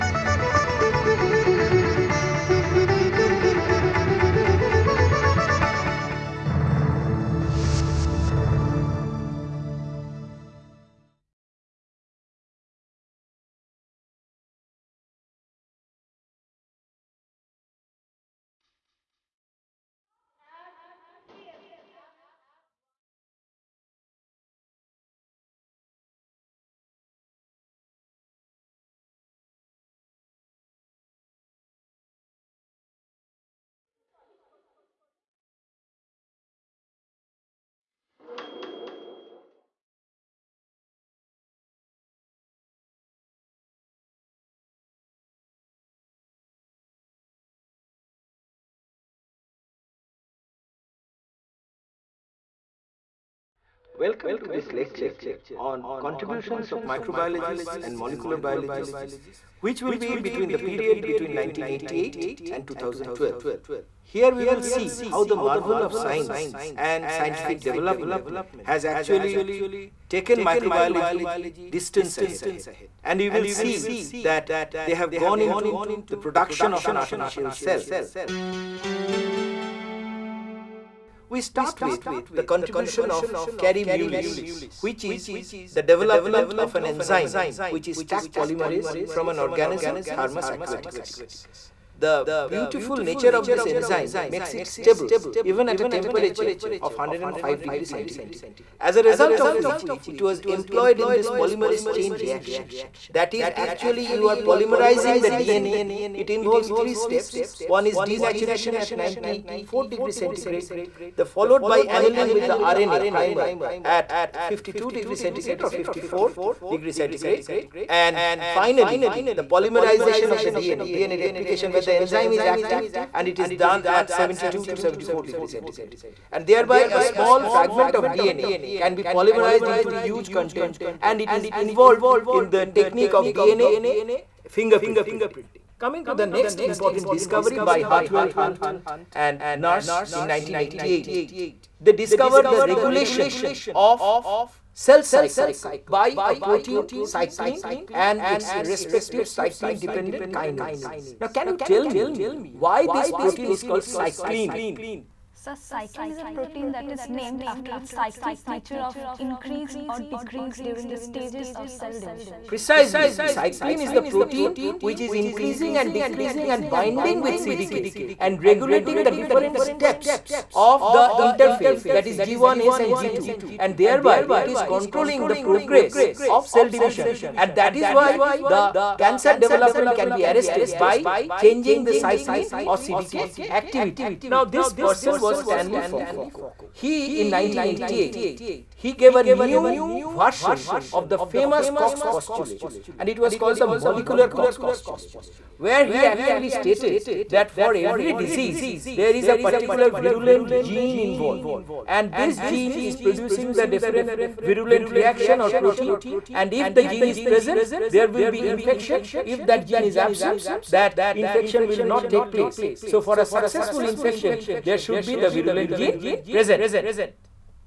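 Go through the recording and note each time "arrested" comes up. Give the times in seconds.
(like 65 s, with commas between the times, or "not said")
180 s.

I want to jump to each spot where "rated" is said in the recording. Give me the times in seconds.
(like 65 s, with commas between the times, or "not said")
not said.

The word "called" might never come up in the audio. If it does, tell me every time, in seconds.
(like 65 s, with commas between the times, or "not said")
153 s, 193 s.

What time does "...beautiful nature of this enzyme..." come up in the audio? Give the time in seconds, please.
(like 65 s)
92 s.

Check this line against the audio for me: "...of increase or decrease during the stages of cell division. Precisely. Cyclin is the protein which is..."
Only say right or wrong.
right.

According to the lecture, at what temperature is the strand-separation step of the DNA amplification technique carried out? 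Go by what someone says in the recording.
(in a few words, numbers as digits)
94 degrees centigrade.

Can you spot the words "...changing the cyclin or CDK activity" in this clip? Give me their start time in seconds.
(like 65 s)
181 s.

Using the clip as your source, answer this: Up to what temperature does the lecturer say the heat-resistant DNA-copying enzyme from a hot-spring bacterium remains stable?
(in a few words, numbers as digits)
105 degrees centigrade.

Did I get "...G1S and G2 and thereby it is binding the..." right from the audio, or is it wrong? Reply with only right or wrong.
wrong.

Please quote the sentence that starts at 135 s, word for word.
Coming to the next important discovery by Hartwell Hunt and Nurse in 1988.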